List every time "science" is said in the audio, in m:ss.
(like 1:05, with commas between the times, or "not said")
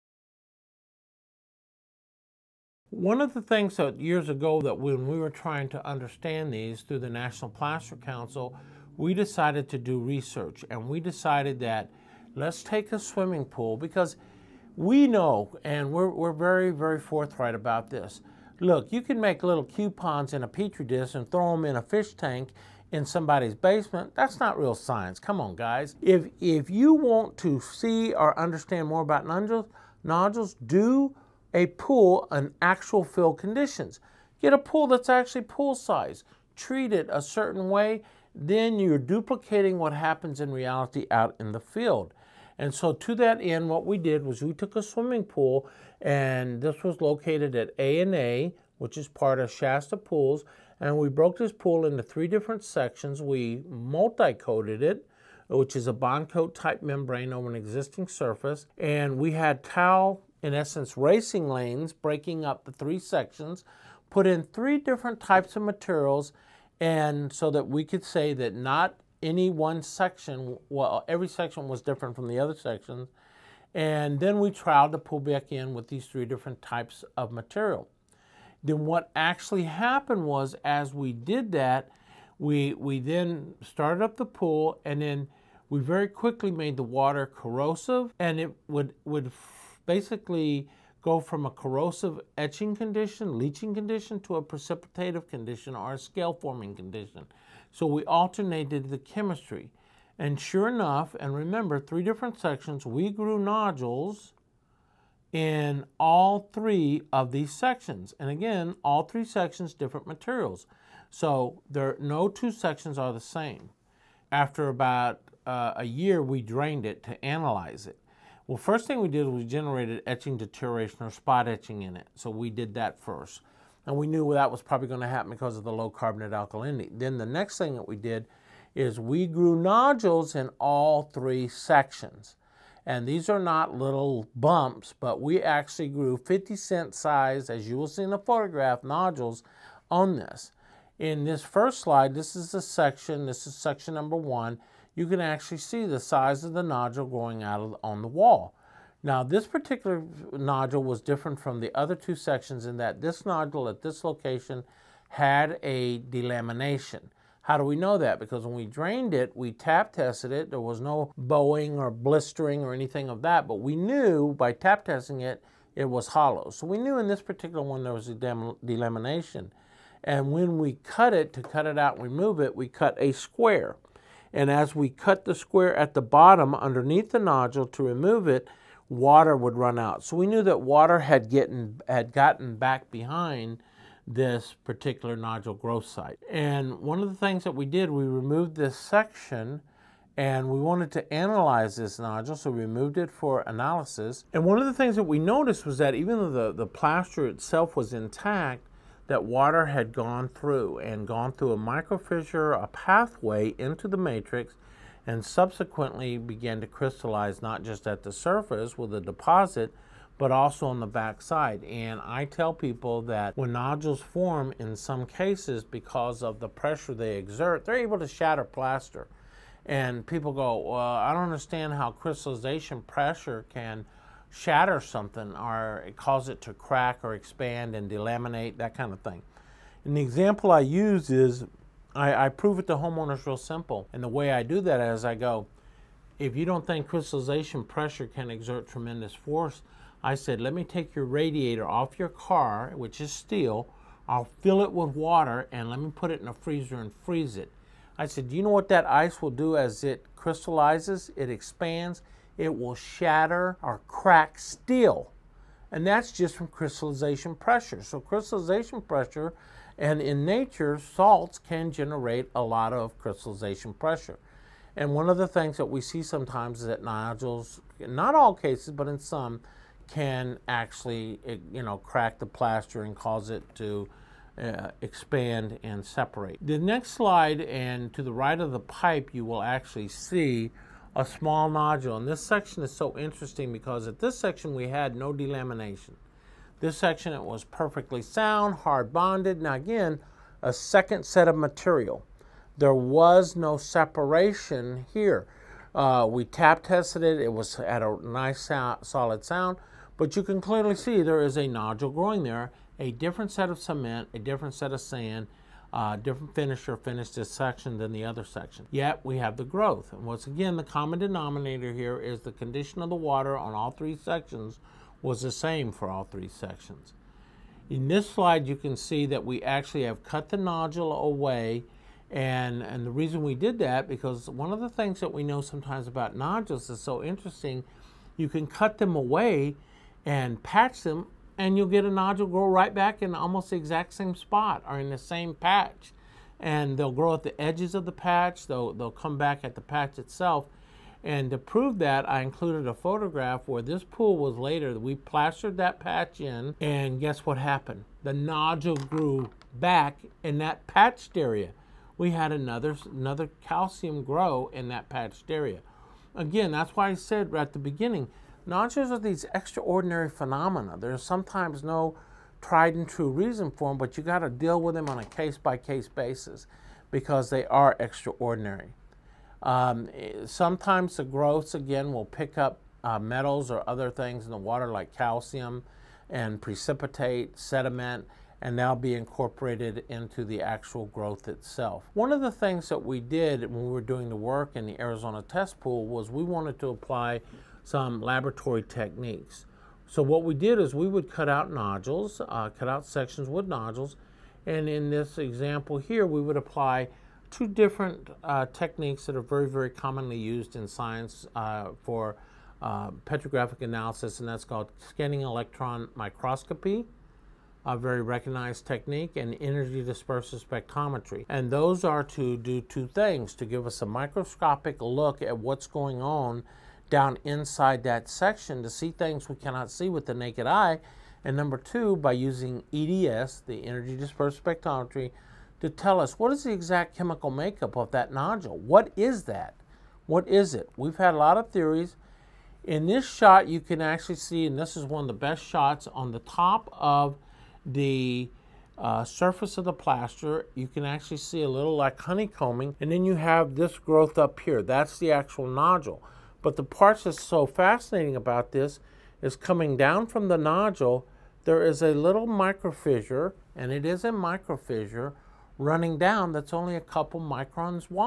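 0:24, 6:40.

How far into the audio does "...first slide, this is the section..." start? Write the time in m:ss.
2:21.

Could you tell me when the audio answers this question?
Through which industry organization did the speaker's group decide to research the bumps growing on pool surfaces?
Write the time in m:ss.
0:07.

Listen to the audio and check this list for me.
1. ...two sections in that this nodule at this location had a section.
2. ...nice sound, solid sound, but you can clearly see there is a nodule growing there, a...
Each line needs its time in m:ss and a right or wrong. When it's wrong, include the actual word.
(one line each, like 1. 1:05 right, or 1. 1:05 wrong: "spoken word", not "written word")
1. 2:31 wrong: "delamination", not "section"
2. 4:58 right.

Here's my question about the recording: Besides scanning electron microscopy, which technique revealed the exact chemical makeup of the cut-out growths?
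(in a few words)
energy dispersive spectrometry.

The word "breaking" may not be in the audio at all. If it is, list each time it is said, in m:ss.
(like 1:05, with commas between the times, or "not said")
1:01.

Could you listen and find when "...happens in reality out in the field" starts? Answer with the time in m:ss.
0:39.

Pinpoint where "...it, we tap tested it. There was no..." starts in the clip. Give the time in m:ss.
2:39.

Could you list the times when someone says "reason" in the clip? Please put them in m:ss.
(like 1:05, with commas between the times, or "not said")
5:22, 6:03.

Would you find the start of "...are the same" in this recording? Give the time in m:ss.
1:52.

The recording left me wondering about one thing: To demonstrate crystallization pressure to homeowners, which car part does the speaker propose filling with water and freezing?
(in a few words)
radiator.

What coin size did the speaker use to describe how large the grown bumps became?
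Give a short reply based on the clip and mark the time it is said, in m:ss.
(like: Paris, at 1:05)
50 cent, at 2:16.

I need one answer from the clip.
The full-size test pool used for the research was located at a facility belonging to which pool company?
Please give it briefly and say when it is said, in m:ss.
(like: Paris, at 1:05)
Shasta Pools, at 0:49.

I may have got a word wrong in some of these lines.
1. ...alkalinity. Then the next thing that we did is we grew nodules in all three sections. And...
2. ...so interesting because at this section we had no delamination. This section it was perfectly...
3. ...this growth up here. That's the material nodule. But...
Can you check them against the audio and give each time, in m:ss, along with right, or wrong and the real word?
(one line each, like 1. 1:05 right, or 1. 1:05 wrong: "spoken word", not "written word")
1. 2:06 right
2. 4:42 right
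3. 7:23 wrong: "actual", not "material".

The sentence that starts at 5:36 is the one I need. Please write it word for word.
And they'll grow at the edges of the patch, they'll, they'll come back at the patch itself.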